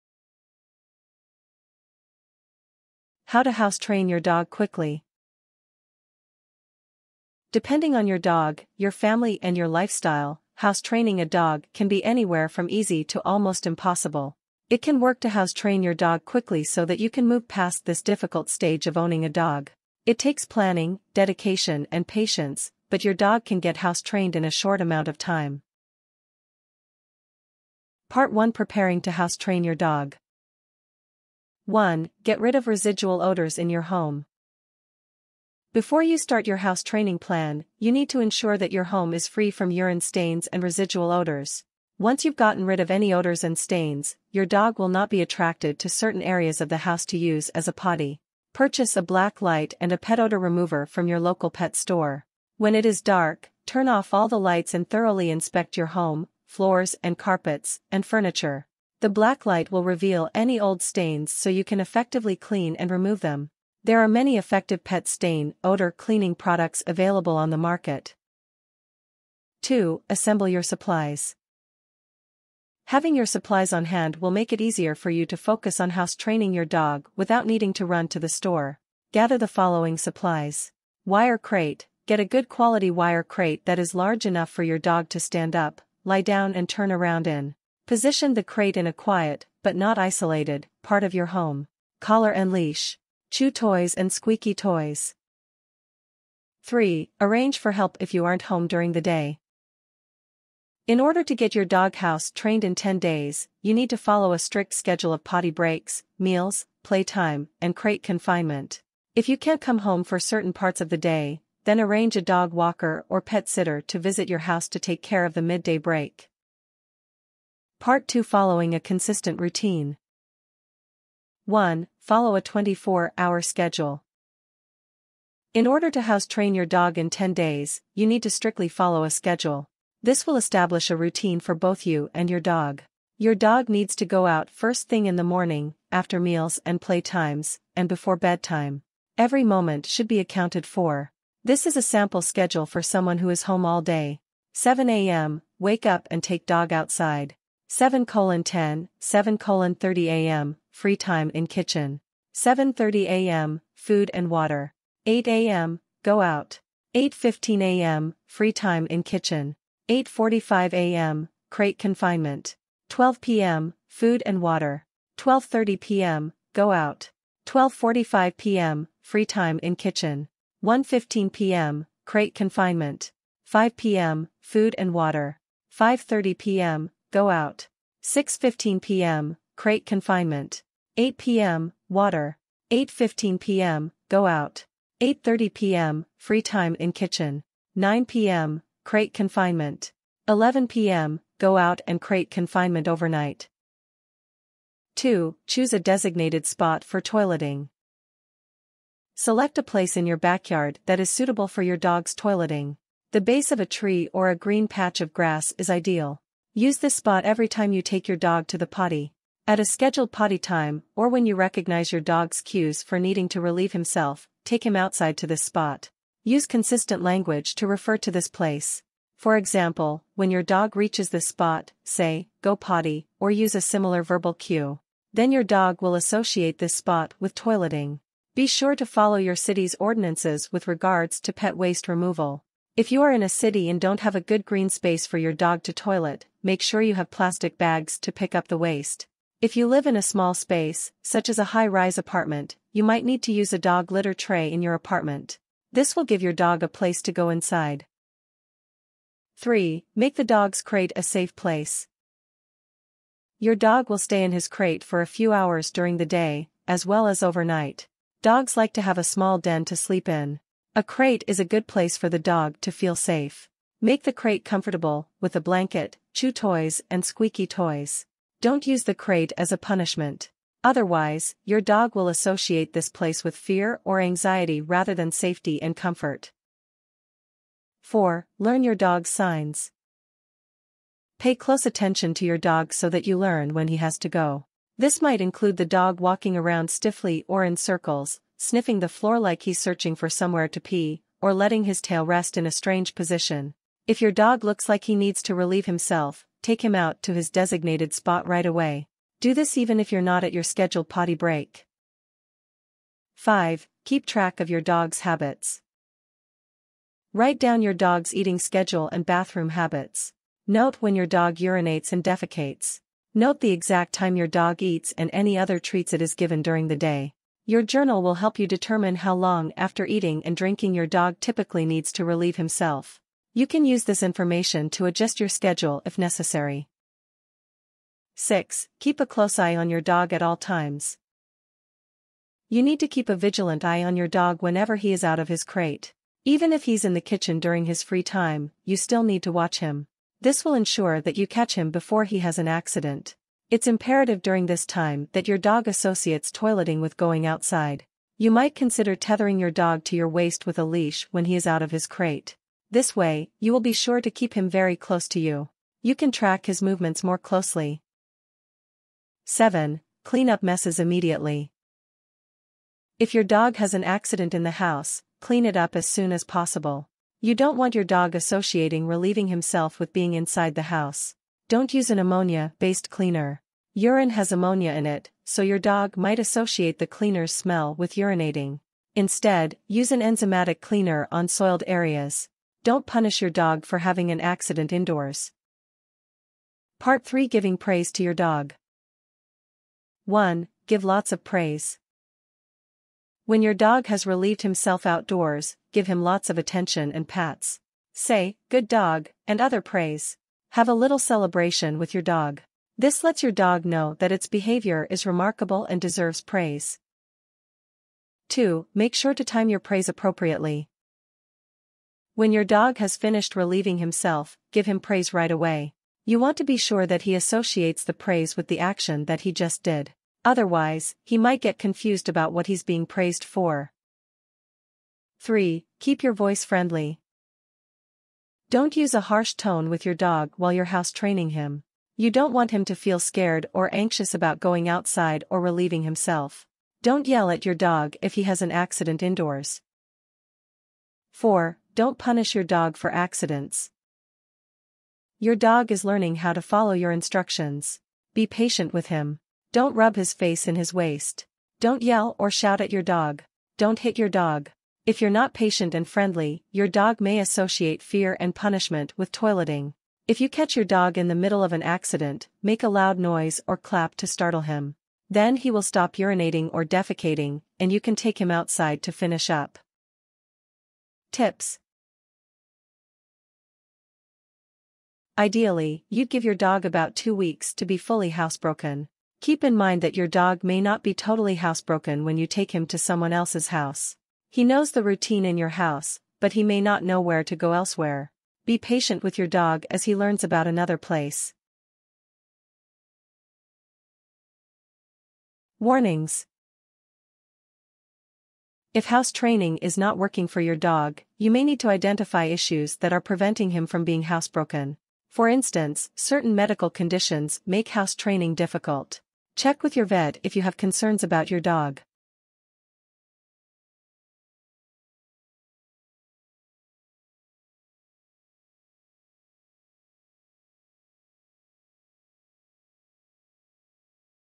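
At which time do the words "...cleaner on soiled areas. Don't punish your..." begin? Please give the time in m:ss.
6:20.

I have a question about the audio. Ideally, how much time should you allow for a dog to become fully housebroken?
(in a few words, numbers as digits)
two weeks.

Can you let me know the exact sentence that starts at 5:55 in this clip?
You can track his movements more closely.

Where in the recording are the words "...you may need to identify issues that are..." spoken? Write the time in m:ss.
8:21.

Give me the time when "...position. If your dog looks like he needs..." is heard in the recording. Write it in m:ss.
4:52.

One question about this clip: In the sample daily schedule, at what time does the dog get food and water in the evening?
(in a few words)
5 p.m.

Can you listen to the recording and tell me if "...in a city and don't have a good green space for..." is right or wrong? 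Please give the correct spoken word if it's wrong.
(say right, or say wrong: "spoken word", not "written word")
right.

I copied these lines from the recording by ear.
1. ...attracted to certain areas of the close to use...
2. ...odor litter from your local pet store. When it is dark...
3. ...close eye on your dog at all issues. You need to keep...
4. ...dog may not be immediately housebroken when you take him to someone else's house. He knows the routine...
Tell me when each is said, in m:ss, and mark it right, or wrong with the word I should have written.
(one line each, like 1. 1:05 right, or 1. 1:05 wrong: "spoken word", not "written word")
1. 0:45 wrong: "house", not "close"
2. 0:50 wrong: "remover", not "litter"
3. 5:29 wrong: "times", not "issues"
4. 8:00 wrong: "totally", not "immediately".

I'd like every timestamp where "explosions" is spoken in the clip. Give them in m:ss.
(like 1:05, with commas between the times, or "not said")
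not said.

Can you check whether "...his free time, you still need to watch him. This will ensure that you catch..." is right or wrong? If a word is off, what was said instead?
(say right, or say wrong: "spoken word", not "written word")
right.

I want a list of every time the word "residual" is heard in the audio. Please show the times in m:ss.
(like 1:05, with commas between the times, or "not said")
0:32, 0:40.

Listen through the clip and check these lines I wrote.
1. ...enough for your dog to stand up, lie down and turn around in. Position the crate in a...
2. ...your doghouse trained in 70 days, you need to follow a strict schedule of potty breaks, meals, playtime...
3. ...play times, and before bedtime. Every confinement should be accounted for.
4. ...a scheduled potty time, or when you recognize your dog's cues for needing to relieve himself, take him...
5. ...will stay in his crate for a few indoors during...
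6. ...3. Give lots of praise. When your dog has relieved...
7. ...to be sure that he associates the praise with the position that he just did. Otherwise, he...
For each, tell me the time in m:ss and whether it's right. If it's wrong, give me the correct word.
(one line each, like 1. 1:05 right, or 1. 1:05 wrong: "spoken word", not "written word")
1. 1:24 right
2. 1:41 wrong: "10", not "70"
3. 2:16 wrong: "moment", not "confinement"
4. 3:29 right
5. 4:13 wrong: "hours", not "indoors"
6. 6:30 wrong: "1", not "3"
7. 6:56 wrong: "action", not "position".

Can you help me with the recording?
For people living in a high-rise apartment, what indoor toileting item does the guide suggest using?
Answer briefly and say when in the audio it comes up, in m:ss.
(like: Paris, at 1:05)
dog litter tray, at 4:03.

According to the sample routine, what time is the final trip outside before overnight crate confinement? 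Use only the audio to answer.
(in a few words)
11 p.m.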